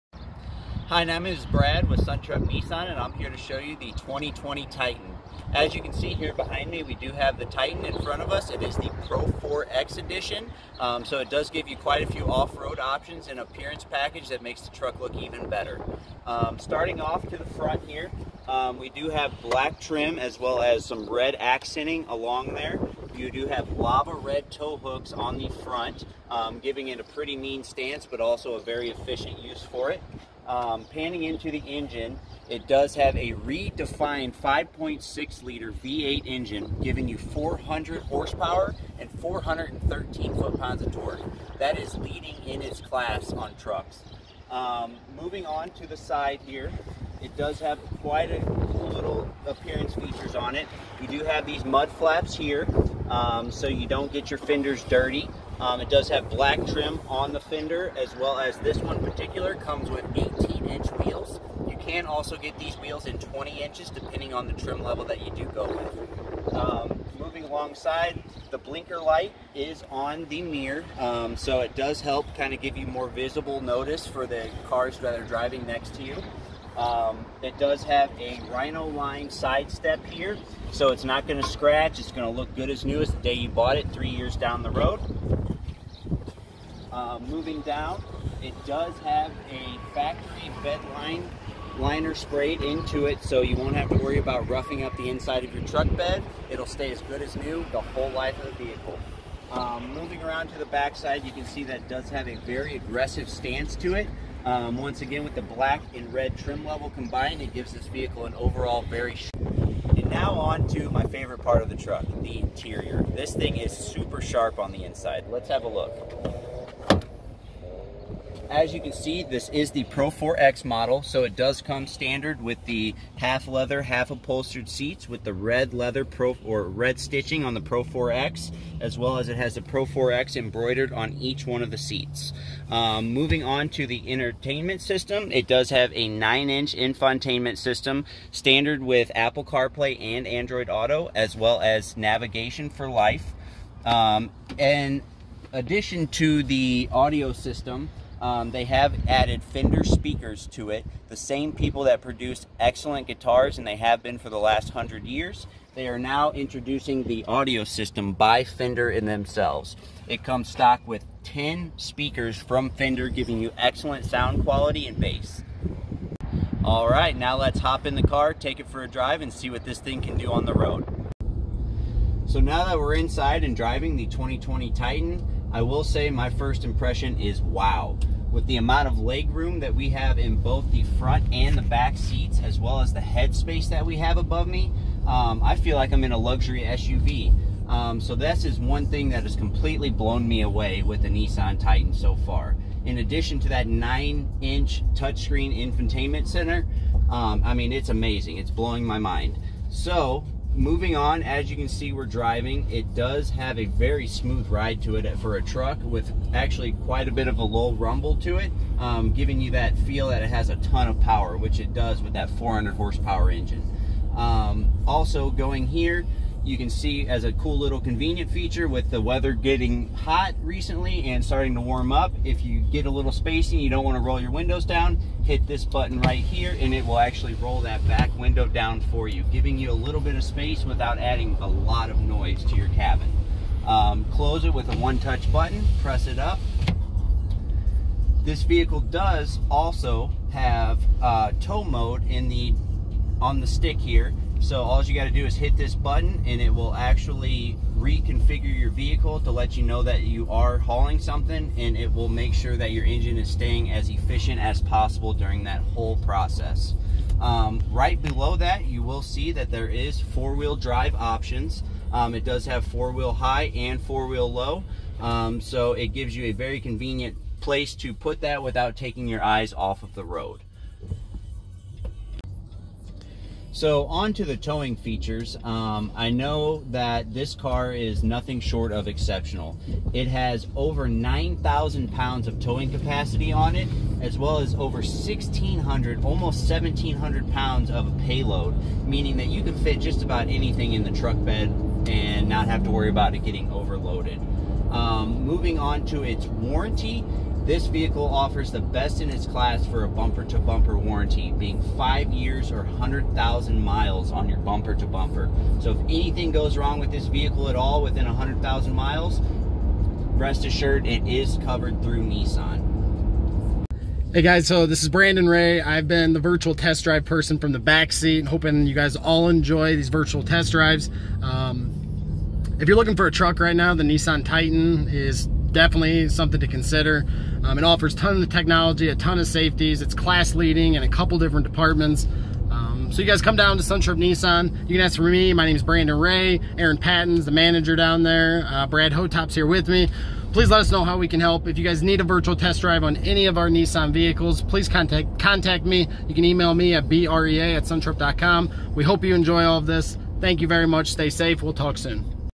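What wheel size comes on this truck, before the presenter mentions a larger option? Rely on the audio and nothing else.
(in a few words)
18 inches.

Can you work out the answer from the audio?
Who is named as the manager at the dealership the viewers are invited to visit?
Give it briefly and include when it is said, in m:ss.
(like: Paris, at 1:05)
Aaron Patton, at 5:36.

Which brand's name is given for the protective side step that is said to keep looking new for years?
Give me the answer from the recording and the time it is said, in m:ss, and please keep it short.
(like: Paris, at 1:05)
Rhino, at 1:18.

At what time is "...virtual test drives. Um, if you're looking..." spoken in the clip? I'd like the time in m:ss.
5:19.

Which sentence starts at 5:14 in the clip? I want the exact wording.
Hey guys, so this is Brandon Ray.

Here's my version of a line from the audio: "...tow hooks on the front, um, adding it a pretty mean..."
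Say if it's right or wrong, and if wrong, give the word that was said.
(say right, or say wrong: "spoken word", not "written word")
wrong: "giving", not "adding".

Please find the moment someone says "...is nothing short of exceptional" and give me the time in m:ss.
4:37.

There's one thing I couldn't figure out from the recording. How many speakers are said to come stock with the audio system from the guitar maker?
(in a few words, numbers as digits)
10.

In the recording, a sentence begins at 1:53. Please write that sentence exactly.
This thing is super sharp on the inside.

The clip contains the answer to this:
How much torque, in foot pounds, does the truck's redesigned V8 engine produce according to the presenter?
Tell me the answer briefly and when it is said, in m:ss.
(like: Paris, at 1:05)
413, at 0:39.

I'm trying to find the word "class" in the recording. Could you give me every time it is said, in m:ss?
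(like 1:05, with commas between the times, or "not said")
0:42, 4:59, 5:29.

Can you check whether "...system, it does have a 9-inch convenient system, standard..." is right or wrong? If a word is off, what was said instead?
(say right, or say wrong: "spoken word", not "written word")
wrong: "infotainment", not "convenient".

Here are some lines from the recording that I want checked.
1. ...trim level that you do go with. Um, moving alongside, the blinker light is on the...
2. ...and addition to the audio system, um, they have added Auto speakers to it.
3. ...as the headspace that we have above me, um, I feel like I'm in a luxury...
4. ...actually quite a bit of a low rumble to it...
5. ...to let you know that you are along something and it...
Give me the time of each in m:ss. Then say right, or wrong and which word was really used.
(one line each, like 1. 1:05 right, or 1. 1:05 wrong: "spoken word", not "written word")
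1. 1:04 right
2. 2:24 wrong: "Fender", not "Auto"
3. 3:02 right
4. 3:26 right
5. 4:09 wrong: "hauling", not "along".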